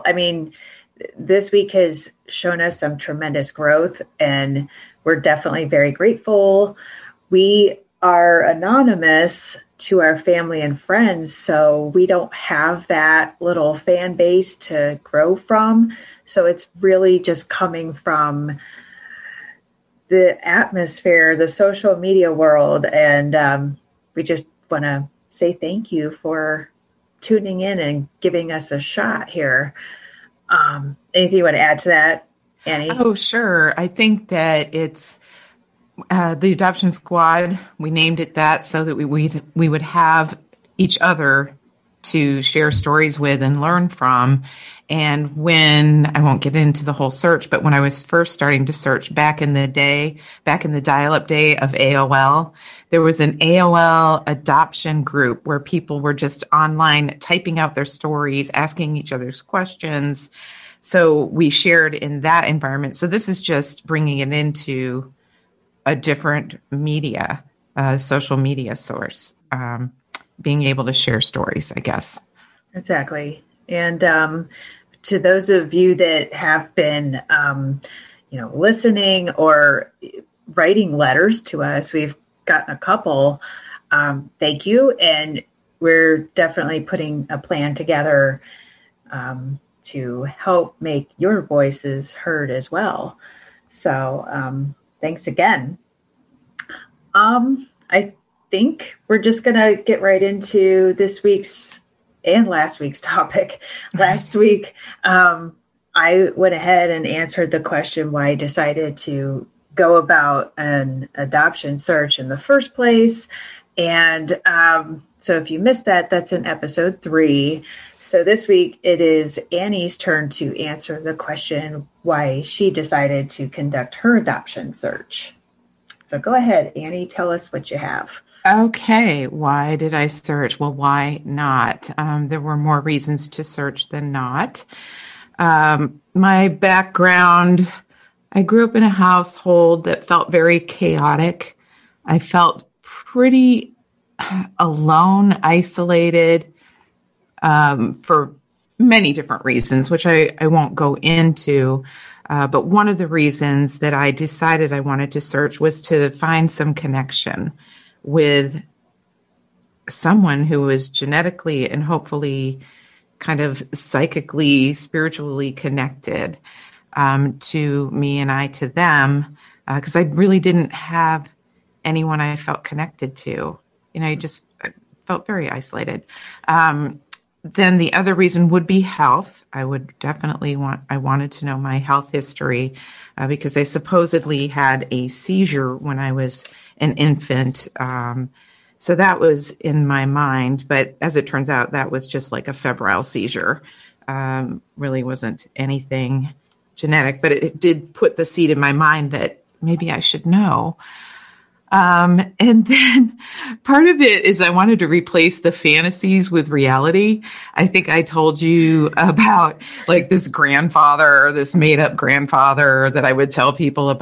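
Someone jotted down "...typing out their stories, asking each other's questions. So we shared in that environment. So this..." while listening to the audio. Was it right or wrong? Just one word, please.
right.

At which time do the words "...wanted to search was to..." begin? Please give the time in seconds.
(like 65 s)
154 s.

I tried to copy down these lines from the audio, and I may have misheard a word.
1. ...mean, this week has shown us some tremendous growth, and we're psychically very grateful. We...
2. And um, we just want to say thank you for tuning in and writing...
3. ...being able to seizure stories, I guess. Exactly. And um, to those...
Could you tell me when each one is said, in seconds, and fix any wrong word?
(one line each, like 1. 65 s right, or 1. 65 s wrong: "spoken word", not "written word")
1. 0 s wrong: "definitely", not "psychically"
2. 22 s wrong: "giving", not "writing"
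3. 70 s wrong: "share", not "seizure".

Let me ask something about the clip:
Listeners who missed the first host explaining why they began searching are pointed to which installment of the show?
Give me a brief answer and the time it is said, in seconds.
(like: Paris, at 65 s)
episode 3, at 116 s.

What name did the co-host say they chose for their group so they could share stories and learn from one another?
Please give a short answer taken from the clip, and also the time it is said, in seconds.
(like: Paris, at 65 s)
the adoption squad, at 36 s.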